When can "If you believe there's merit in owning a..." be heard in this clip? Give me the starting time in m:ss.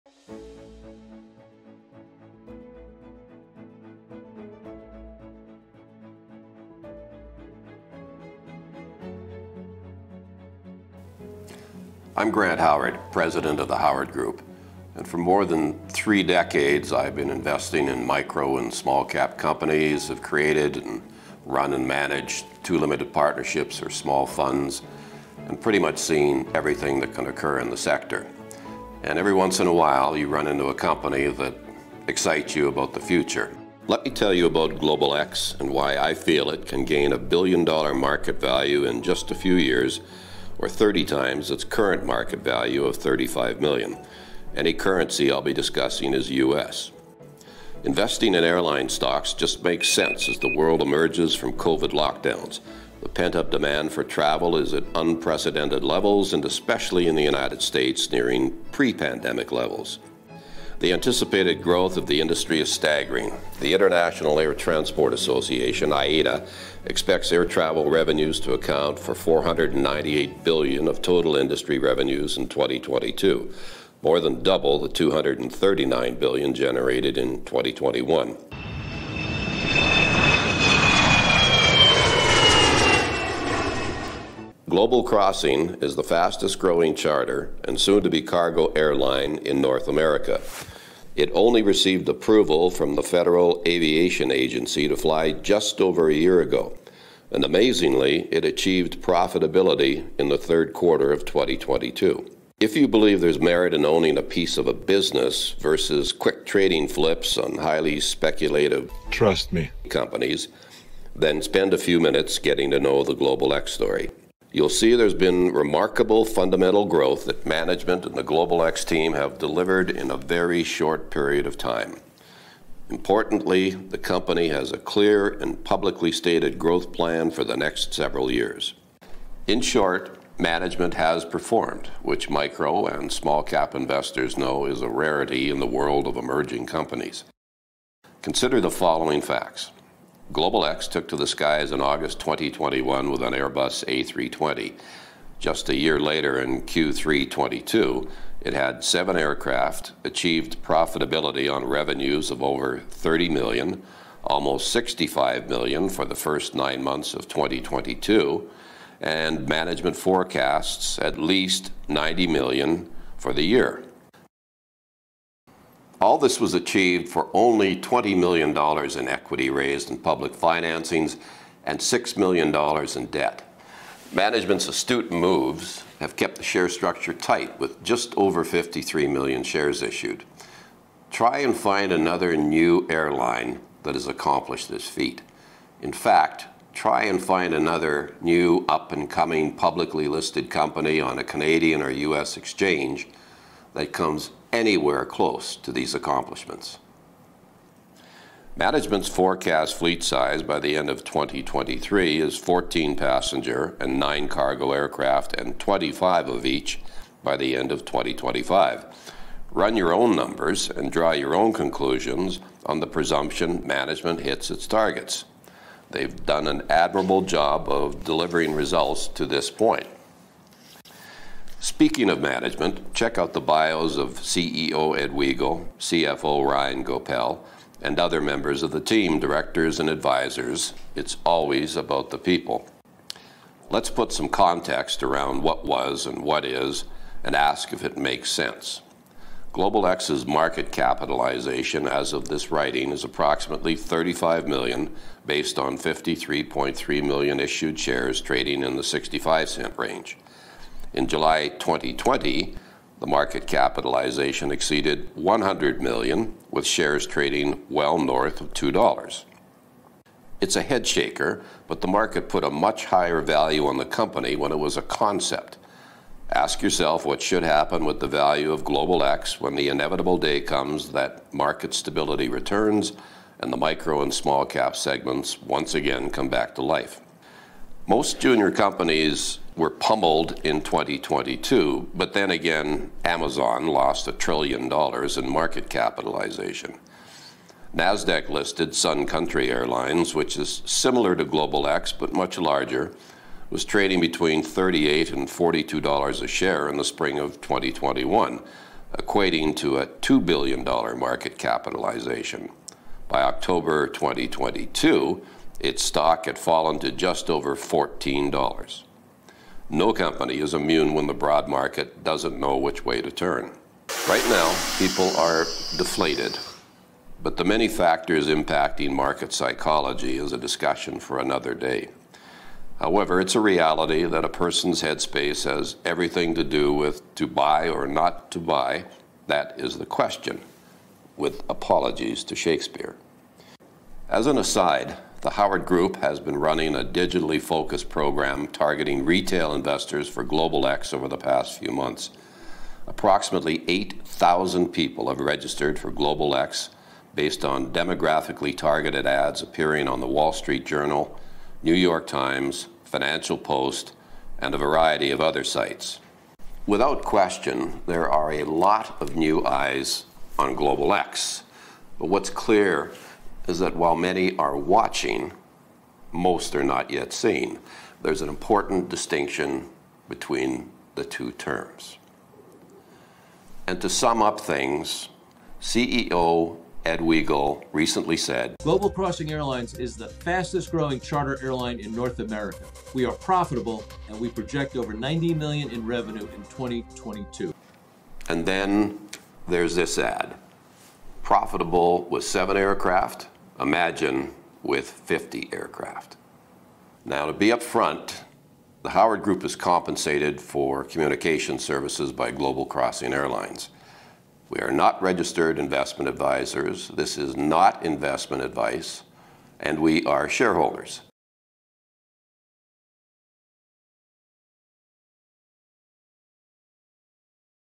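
1:42.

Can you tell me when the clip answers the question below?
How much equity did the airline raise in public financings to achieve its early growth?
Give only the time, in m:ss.
2:47.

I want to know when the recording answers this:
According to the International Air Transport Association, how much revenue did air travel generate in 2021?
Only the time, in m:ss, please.
1:14.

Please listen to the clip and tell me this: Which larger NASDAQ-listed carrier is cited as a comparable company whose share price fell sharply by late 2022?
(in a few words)
Sun Country Airlines.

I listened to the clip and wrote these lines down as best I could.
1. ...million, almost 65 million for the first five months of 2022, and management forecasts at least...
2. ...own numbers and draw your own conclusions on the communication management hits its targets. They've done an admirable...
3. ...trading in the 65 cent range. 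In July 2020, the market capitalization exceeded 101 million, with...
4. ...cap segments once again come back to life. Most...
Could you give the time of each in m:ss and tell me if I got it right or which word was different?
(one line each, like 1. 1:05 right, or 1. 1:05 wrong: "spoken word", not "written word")
1. 2:33 wrong: "nine", not "five"
2. 3:29 wrong: "presumption", not "communication"
3. 4:08 wrong: "100", not "101"
4. 4:34 right.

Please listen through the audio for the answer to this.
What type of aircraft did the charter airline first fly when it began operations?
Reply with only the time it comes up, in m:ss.
2:23.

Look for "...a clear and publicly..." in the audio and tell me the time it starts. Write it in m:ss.
2:04.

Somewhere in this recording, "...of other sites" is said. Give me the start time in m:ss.
5:55.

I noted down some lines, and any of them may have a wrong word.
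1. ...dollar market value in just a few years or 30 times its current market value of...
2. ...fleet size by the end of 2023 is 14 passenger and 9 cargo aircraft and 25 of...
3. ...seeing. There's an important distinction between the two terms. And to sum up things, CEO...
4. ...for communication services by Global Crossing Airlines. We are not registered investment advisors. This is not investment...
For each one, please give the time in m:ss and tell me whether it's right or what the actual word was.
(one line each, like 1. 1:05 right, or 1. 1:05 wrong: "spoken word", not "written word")
1. 0:37 right
2. 3:19 right
3. 6:07 right
4. 6:40 right.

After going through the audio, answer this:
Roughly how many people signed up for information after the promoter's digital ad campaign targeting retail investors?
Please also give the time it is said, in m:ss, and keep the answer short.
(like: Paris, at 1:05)
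8,000, at 5:43.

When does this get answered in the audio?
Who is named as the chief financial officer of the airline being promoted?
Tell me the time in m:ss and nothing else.
3:46.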